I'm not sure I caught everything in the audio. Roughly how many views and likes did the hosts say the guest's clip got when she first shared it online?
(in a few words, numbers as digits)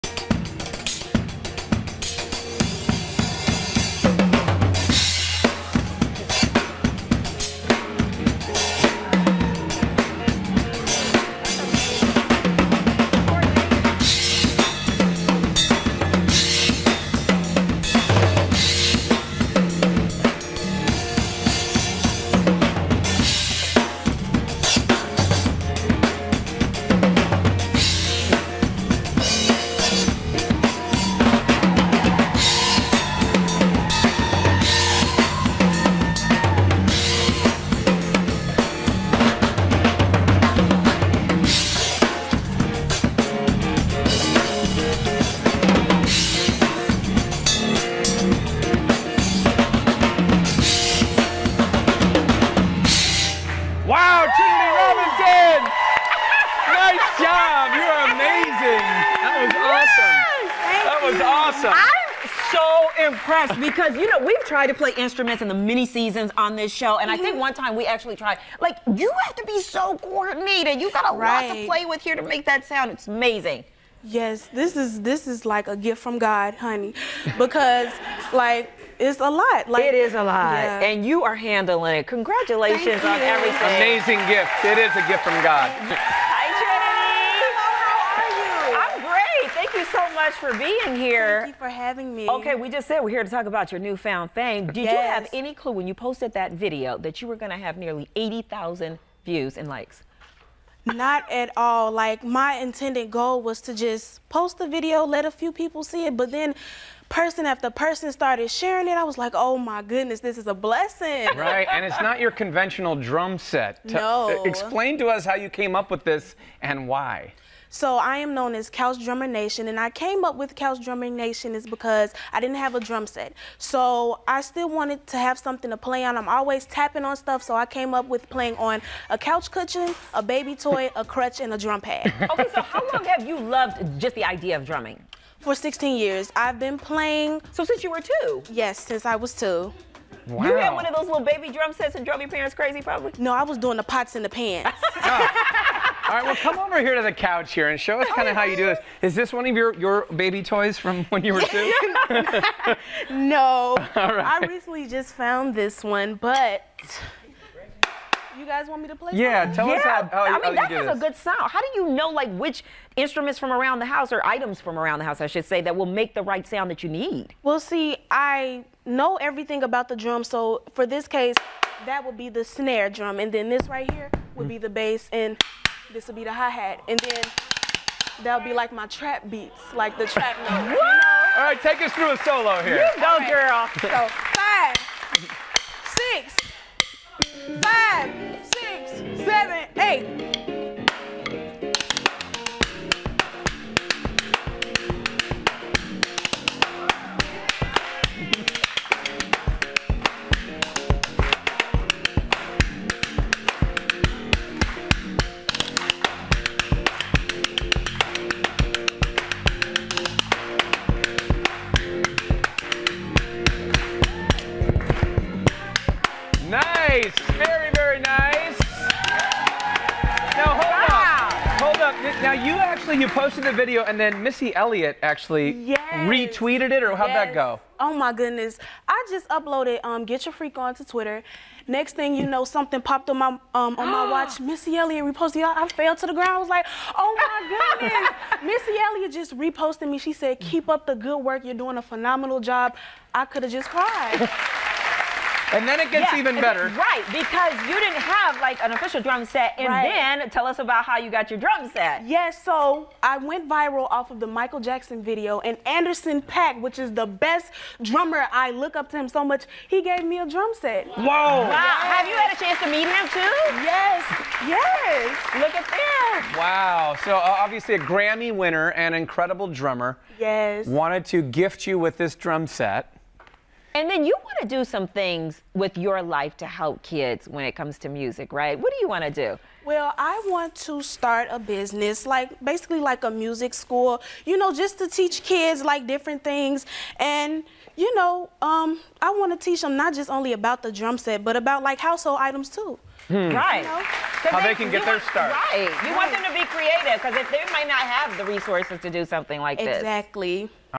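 80,000.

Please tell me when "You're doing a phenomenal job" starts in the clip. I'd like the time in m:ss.
4:01.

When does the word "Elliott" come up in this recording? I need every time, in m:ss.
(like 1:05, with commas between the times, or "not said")
3:44, 3:54, 3:58.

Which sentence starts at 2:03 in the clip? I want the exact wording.
So I still wanted to have something to play on.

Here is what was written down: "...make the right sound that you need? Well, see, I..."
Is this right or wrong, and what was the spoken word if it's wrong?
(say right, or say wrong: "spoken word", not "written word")
right.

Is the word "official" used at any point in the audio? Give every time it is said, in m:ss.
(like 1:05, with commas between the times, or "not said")
4:08.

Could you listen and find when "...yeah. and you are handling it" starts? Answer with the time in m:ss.
1:20.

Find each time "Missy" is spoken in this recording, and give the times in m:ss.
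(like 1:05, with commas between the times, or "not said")
3:44, 3:54, 3:58.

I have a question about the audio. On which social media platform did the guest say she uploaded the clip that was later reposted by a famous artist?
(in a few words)
Twitter.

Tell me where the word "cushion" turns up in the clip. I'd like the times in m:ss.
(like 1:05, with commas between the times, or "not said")
2:09.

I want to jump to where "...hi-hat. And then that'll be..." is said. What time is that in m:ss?
2:56.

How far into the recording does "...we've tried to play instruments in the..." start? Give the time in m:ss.
1:04.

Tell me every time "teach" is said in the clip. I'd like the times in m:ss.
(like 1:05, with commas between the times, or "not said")
4:44, 4:49.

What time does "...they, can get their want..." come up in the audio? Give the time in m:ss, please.
4:54.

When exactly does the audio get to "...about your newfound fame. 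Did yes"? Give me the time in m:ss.
1:33.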